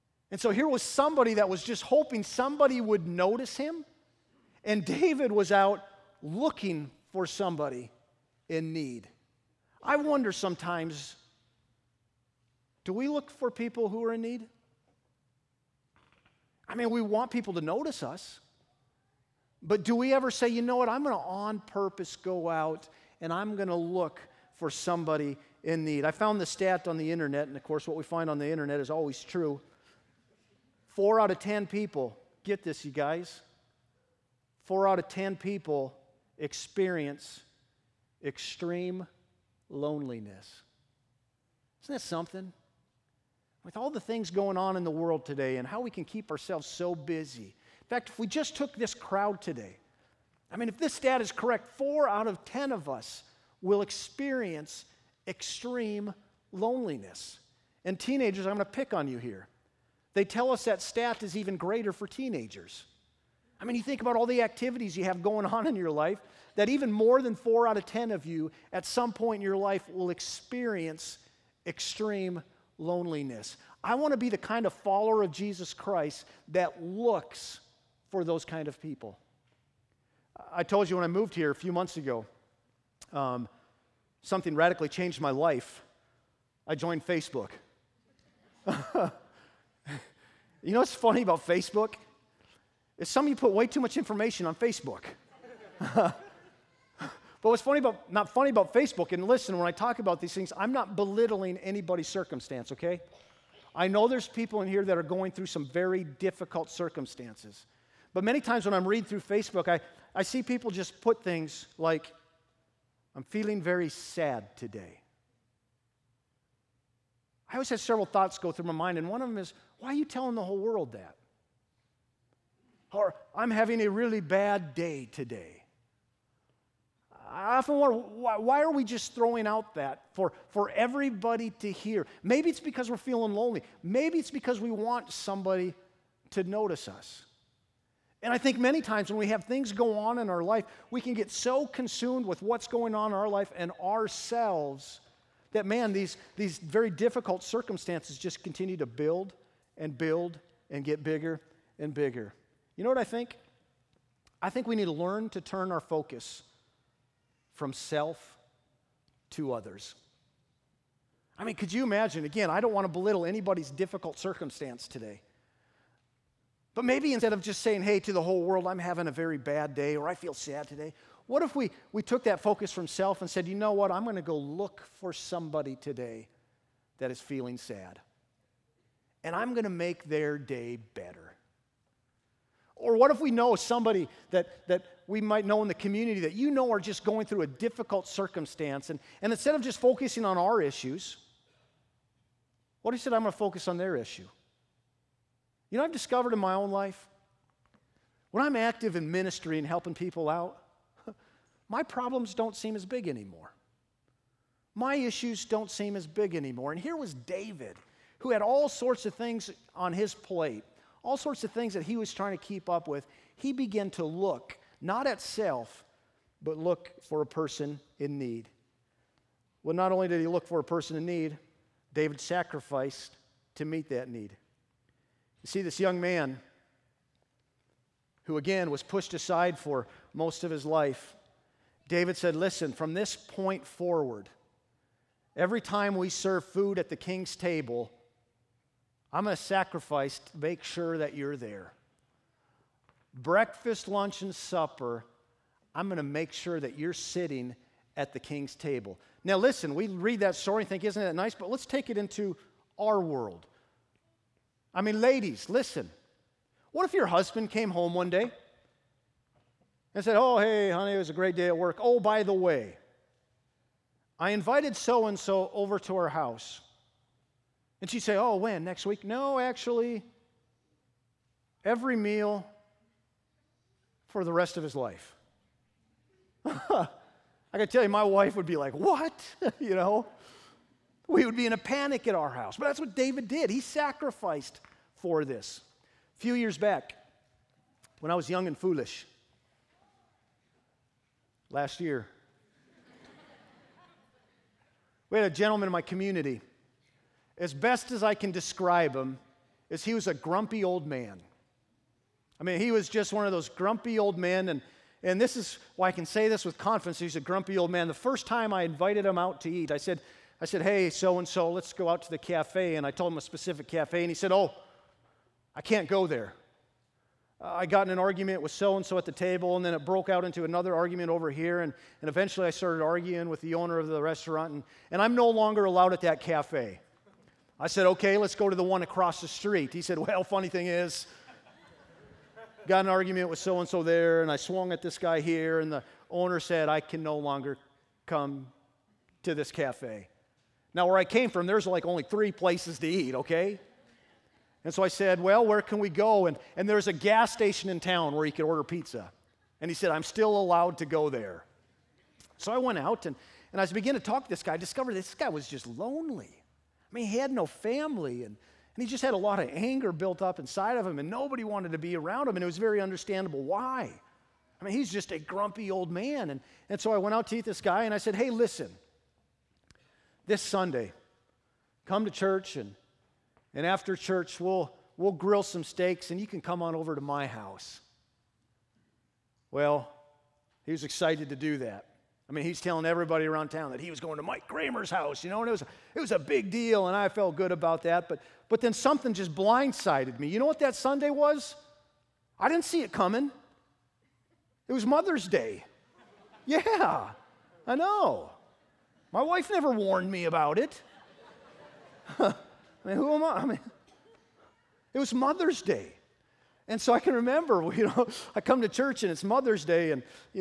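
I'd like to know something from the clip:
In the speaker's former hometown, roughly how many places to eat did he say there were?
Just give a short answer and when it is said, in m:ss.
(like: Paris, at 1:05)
3, at 5:41.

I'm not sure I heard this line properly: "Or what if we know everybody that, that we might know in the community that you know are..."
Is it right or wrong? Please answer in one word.
wrong.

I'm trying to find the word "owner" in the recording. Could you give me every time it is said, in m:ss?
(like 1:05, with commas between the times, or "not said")
5:23, 5:36.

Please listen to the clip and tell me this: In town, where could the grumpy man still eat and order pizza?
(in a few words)
A gas station.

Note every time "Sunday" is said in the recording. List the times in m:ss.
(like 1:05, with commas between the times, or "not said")
6:10, 6:30.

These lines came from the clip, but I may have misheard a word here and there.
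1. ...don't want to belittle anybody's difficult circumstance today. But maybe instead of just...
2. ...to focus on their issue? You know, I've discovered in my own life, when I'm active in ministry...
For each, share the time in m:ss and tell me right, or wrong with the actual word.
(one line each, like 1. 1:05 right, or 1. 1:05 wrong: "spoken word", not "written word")
1. 2:42 right
2. 3:13 right.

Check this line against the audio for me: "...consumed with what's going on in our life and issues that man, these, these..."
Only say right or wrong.
wrong.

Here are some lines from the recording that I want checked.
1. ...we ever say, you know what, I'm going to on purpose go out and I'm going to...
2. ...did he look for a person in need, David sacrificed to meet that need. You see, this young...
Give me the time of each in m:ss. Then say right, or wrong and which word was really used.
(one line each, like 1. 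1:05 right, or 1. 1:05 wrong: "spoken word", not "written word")
1. 0:19 right
2. 3:40 right.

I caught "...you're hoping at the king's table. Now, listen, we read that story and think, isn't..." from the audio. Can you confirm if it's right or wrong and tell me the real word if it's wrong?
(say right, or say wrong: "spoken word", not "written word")
wrong: "sitting", not "hoping".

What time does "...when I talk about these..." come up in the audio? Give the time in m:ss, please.
1:39.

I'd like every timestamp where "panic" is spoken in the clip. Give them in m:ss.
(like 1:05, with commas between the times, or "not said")
4:41.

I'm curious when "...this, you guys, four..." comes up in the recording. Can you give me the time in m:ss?
0:32.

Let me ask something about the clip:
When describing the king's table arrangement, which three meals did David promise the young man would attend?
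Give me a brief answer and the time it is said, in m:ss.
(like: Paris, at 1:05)
Breakfast, lunch, and supper, at 4:03.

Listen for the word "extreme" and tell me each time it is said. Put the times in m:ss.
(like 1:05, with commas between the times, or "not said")
0:38, 0:55, 1:11.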